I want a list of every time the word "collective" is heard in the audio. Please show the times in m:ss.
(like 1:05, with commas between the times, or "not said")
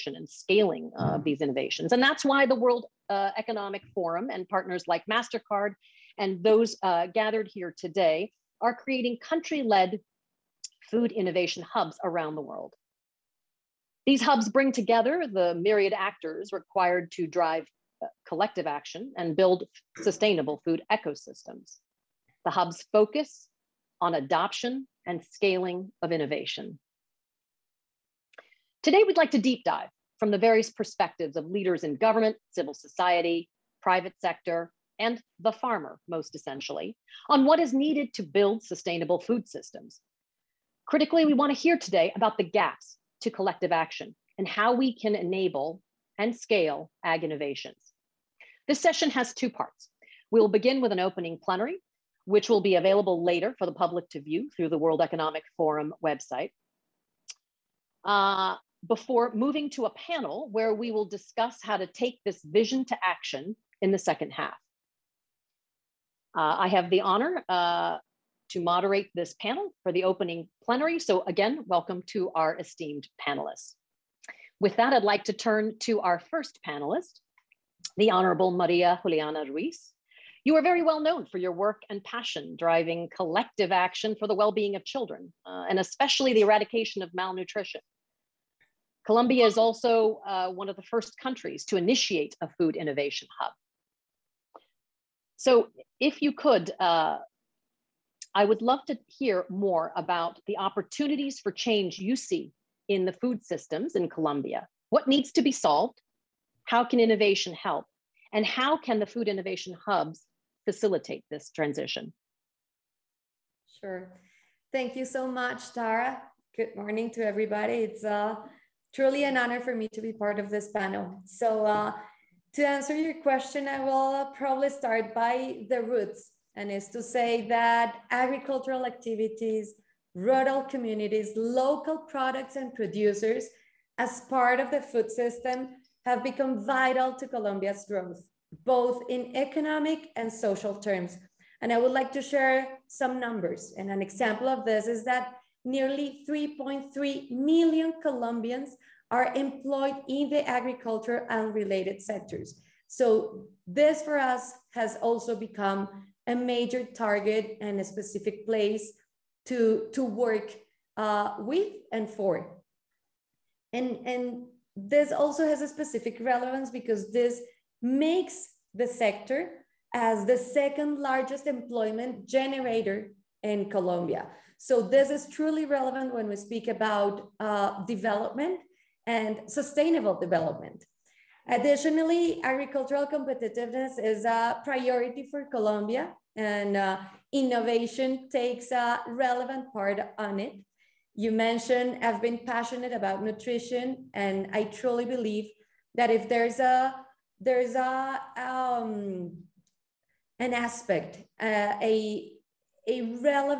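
0:18, 0:43, 1:23.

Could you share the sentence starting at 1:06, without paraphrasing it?
Uh, I have the honor uh, to moderate this panel for the opening plenary.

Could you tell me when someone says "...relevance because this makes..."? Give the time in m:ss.
2:46.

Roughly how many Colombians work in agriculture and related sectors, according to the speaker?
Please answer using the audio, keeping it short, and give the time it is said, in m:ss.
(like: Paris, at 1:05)
3.3 million, at 2:26.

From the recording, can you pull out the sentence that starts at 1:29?
Colombia is also uh, one of the first countries to initiate a food innovation hub.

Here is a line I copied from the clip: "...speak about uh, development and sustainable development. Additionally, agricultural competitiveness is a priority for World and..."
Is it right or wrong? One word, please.
wrong.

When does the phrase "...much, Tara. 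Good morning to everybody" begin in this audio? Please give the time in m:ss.
1:55.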